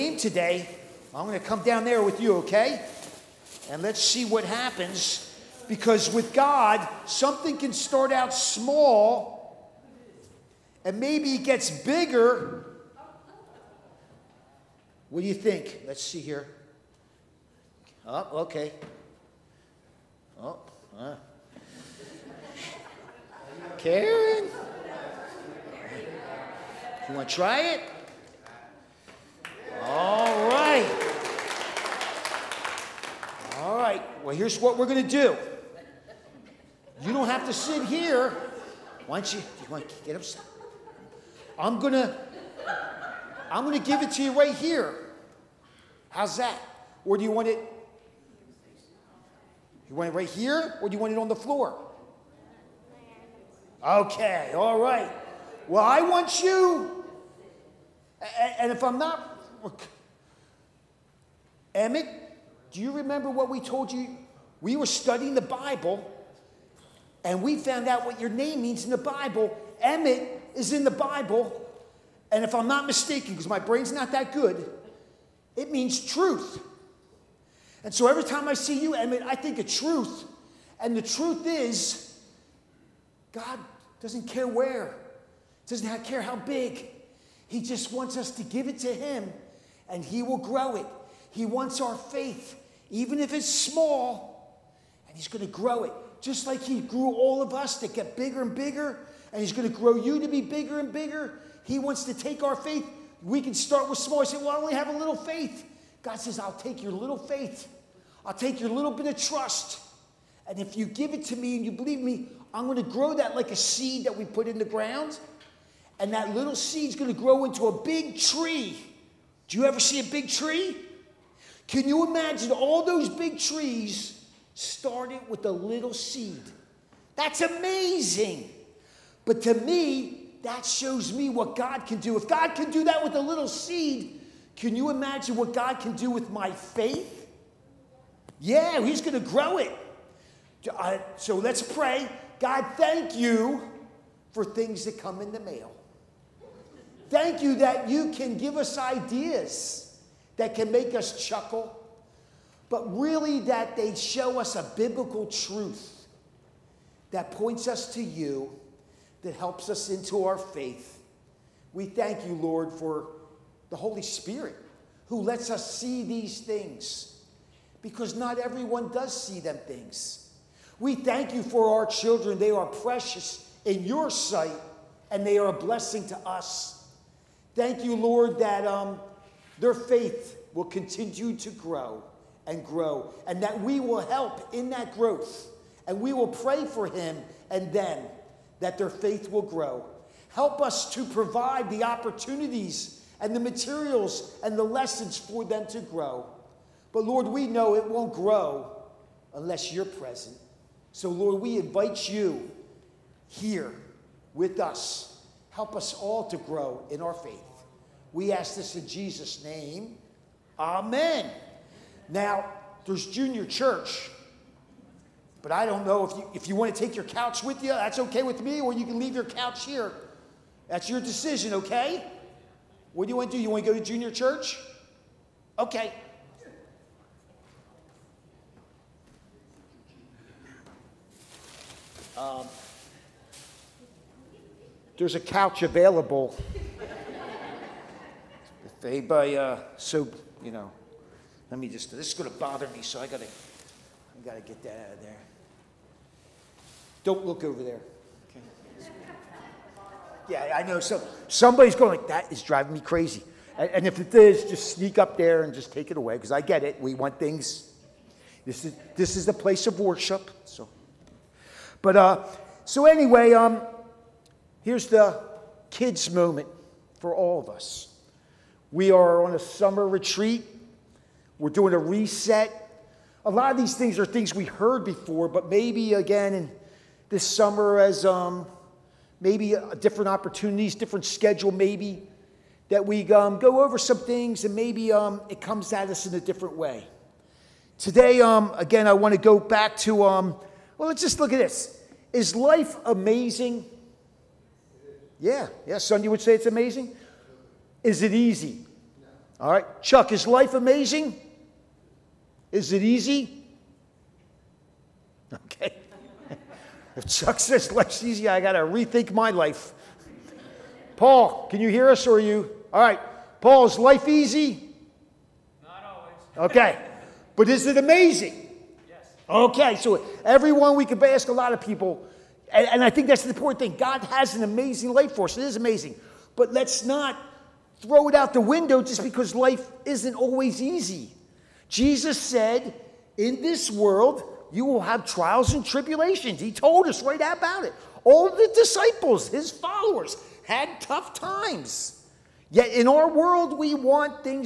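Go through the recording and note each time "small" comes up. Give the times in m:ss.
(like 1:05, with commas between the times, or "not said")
0:08, 1:33, 1:43.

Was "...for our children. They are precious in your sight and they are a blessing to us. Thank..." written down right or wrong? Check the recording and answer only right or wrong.
right.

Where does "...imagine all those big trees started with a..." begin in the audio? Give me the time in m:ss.
2:02.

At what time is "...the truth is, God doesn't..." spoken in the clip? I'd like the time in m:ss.
1:20.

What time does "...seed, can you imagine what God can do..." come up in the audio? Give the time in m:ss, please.
2:13.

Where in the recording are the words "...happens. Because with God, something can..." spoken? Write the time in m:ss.
0:04.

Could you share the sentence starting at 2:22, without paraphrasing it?
God, thank you for things that come in the mail.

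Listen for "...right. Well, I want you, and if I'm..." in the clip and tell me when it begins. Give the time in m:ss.
0:54.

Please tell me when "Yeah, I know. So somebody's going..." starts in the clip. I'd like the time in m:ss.
4:10.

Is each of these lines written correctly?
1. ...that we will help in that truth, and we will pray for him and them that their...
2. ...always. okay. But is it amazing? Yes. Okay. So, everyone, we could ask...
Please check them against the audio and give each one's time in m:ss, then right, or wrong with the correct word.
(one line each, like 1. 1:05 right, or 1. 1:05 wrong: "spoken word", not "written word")
1. 3:03 wrong: "growth", not "truth"
2. 5:15 right.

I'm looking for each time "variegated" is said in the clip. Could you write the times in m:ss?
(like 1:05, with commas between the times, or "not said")
not said.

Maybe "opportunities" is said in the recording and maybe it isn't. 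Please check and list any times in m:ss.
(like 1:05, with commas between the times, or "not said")
3:11, 4:40.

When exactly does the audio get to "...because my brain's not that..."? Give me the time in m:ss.
1:13.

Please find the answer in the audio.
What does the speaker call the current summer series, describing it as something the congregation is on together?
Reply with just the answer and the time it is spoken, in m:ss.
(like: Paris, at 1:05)
summer retreat, at 4:29.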